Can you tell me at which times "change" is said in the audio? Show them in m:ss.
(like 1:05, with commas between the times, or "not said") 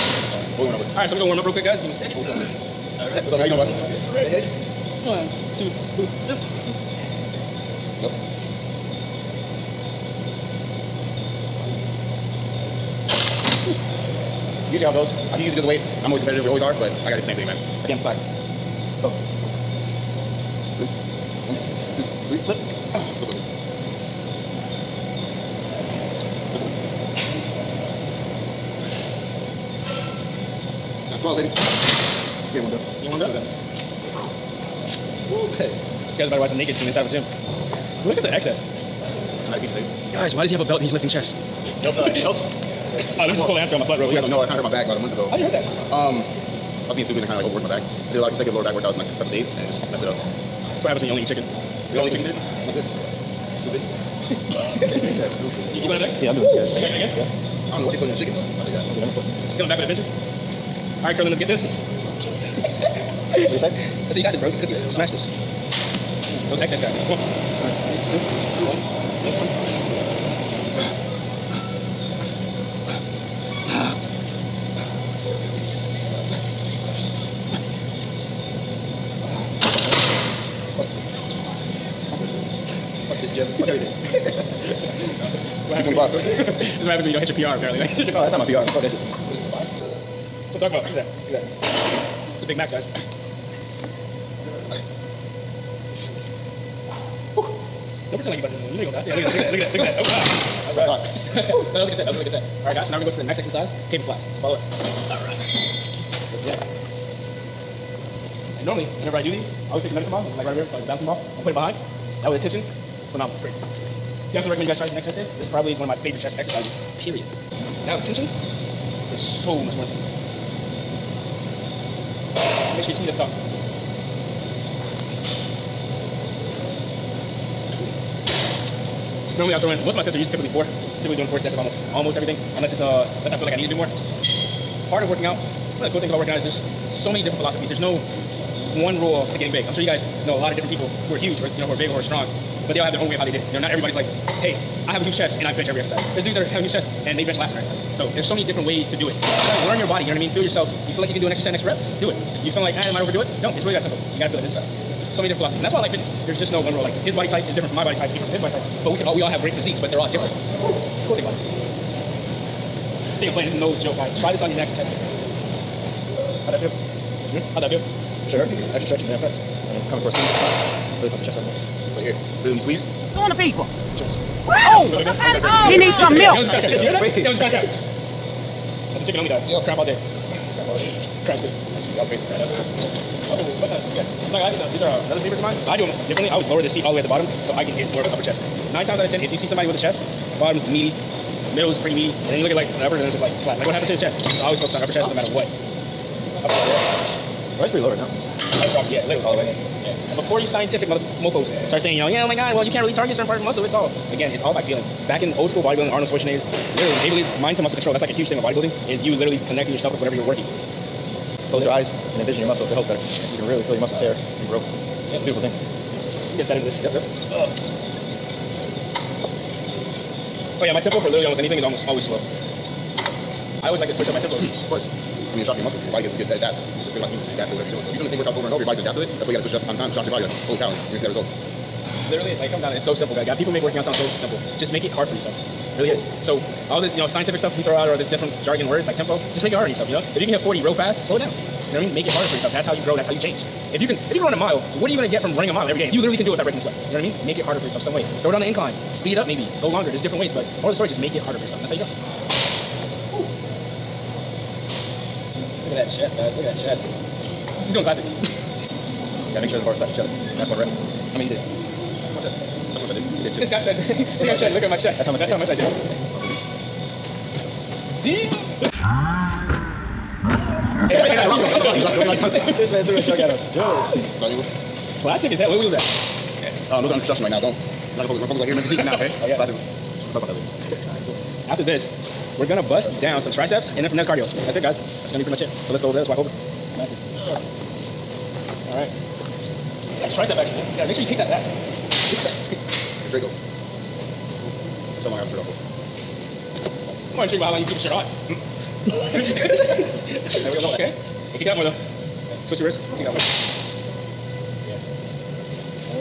4:03.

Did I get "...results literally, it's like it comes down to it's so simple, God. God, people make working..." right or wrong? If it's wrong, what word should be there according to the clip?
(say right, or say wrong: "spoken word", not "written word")
right.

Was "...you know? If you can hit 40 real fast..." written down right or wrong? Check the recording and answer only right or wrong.
right.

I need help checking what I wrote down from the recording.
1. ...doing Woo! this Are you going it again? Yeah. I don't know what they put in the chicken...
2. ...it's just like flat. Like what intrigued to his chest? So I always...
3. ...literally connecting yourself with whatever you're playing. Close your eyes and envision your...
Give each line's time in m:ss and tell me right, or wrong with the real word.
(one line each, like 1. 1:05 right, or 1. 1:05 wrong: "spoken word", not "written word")
1. 0:56 right
2. 3:12 wrong: "happened", not "intrigued"
3. 3:29 wrong: "working", not "playing".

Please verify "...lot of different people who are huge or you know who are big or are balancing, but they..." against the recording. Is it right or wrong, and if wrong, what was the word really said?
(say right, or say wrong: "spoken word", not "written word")
wrong: "strong", not "balancing".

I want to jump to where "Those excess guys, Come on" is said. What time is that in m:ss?
1:06.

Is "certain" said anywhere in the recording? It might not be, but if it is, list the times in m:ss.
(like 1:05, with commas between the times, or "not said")
3:23.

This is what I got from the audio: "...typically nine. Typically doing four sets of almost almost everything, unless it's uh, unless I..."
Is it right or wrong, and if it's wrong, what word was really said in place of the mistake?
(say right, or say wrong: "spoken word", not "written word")
wrong: "four", not "nine".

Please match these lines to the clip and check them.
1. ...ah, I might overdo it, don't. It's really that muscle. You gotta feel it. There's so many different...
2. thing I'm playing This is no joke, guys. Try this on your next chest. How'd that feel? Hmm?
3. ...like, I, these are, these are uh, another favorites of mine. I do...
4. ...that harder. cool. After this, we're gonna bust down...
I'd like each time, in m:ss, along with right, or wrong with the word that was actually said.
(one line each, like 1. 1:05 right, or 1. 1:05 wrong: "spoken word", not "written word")
1. 2:32 wrong: "simple", not "muscle"
2. 2:43 right
3. 3:04 right
4. 4:40 wrong: "later", not "harder".